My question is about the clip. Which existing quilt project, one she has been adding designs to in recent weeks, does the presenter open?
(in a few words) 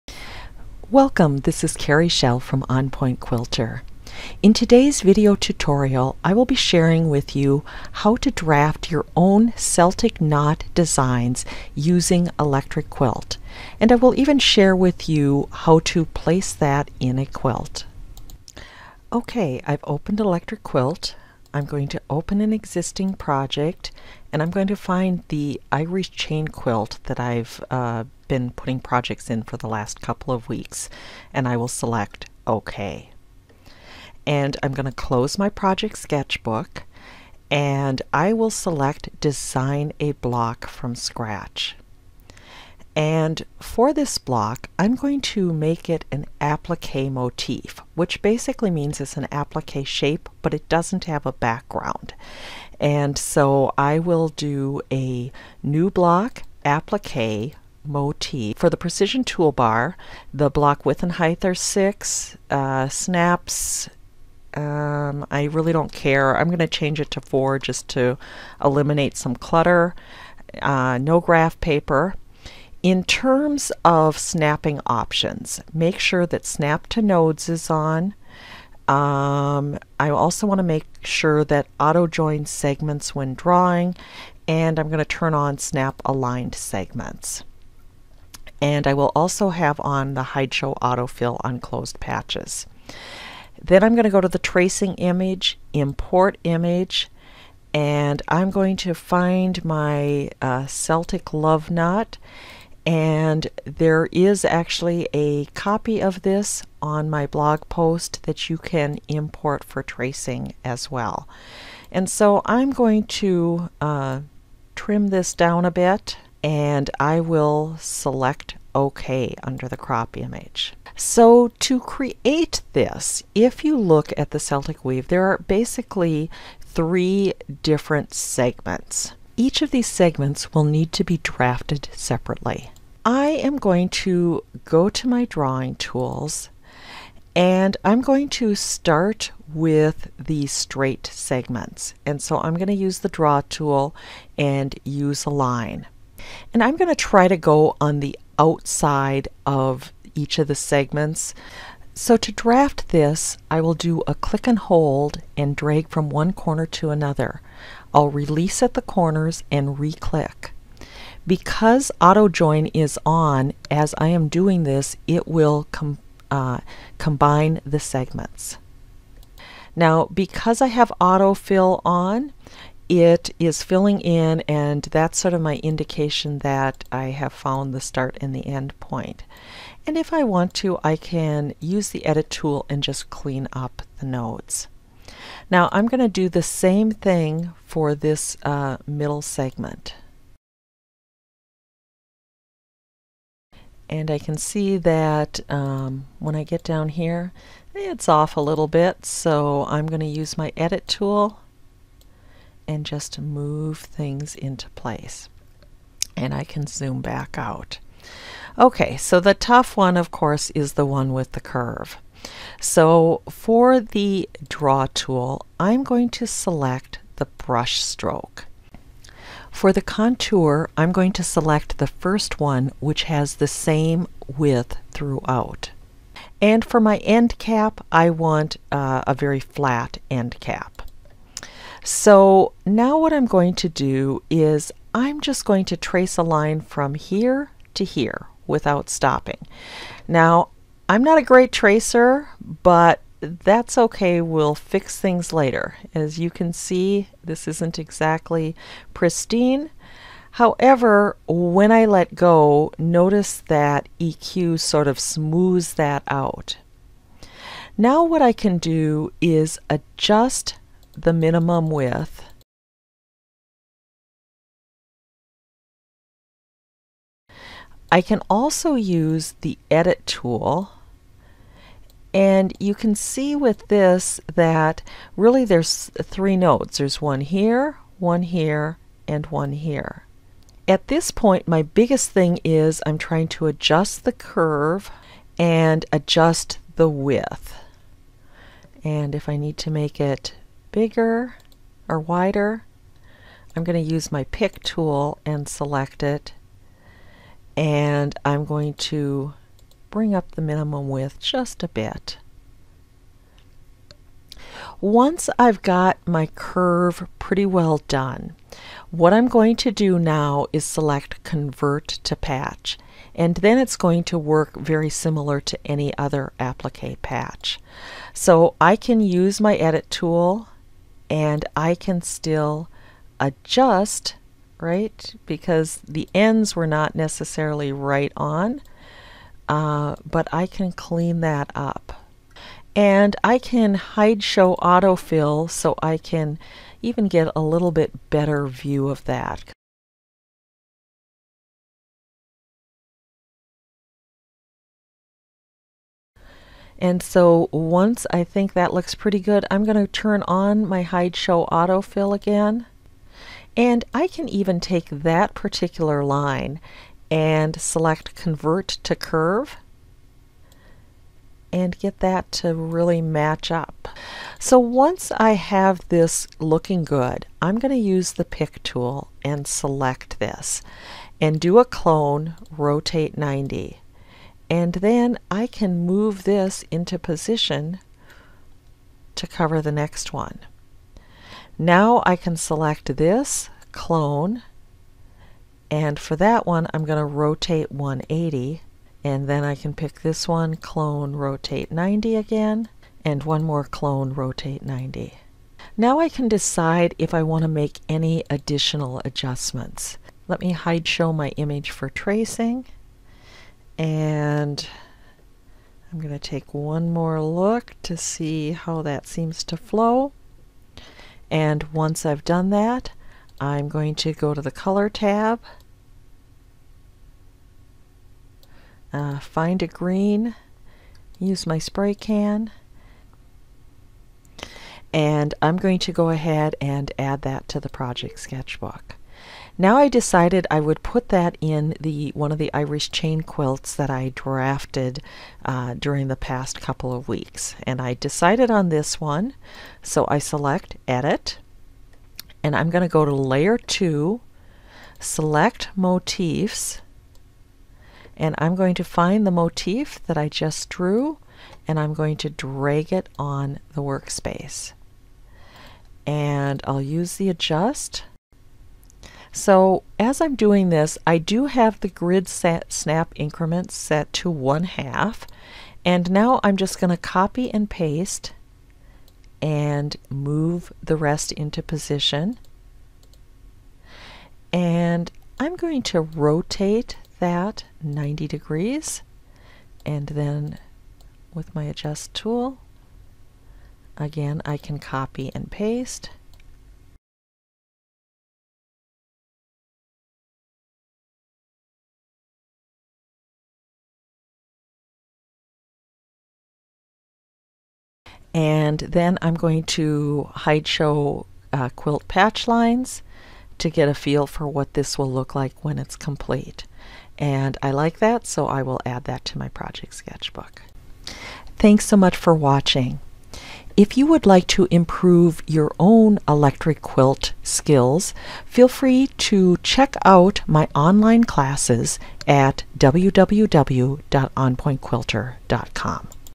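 Irish chain quilt.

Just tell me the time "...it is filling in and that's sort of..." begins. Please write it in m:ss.
2:52.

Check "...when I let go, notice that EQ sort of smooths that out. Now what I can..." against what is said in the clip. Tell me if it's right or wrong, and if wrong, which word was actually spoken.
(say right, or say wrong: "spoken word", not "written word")
right.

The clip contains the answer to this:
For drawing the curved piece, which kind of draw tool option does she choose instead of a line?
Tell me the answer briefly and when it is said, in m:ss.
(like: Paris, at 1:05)
brush stroke, at 3:37.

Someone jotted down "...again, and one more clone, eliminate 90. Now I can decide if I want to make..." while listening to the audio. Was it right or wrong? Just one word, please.
wrong.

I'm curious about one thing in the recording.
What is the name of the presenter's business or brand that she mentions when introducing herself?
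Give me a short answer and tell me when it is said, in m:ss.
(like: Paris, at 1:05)
On Point Quilter, at 0:02.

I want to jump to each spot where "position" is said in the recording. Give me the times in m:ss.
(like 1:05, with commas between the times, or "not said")
6:16, 7:51.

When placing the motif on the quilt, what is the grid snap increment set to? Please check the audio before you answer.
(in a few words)
one half.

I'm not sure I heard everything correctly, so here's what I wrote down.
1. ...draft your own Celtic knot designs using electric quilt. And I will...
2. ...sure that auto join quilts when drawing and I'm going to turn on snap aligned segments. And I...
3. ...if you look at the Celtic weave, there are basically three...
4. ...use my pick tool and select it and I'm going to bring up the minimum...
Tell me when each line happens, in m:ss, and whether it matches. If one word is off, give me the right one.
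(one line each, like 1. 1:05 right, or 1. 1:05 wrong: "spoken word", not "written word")
1. 0:08 right
2. 1:21 wrong: "segments", not "quilts"
3. 2:03 right
4. 4:53 right.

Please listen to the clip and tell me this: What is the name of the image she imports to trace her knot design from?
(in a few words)
Celtic love knot.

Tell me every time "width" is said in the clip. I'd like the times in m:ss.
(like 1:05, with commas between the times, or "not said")
1:00, 3:44, 4:21, 4:46, 5:00.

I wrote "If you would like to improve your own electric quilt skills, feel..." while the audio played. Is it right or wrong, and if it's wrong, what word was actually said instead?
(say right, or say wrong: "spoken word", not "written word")
right.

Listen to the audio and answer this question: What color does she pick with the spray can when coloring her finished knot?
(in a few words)
green.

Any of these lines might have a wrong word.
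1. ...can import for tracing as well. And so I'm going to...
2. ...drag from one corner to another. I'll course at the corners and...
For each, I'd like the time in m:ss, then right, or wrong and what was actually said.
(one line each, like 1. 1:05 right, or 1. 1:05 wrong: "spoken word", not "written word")
1. 1:48 right
2. 2:35 wrong: "release", not "course".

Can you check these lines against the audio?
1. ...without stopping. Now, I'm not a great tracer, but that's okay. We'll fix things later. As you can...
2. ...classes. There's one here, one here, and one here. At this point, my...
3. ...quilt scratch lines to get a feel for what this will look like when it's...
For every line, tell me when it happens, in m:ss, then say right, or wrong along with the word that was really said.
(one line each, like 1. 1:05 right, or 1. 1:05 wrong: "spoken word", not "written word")
1. 3:58 right
2. 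4:36 wrong: "nodes", not "classes"
3. 8:21 wrong: "patch", not "scratch".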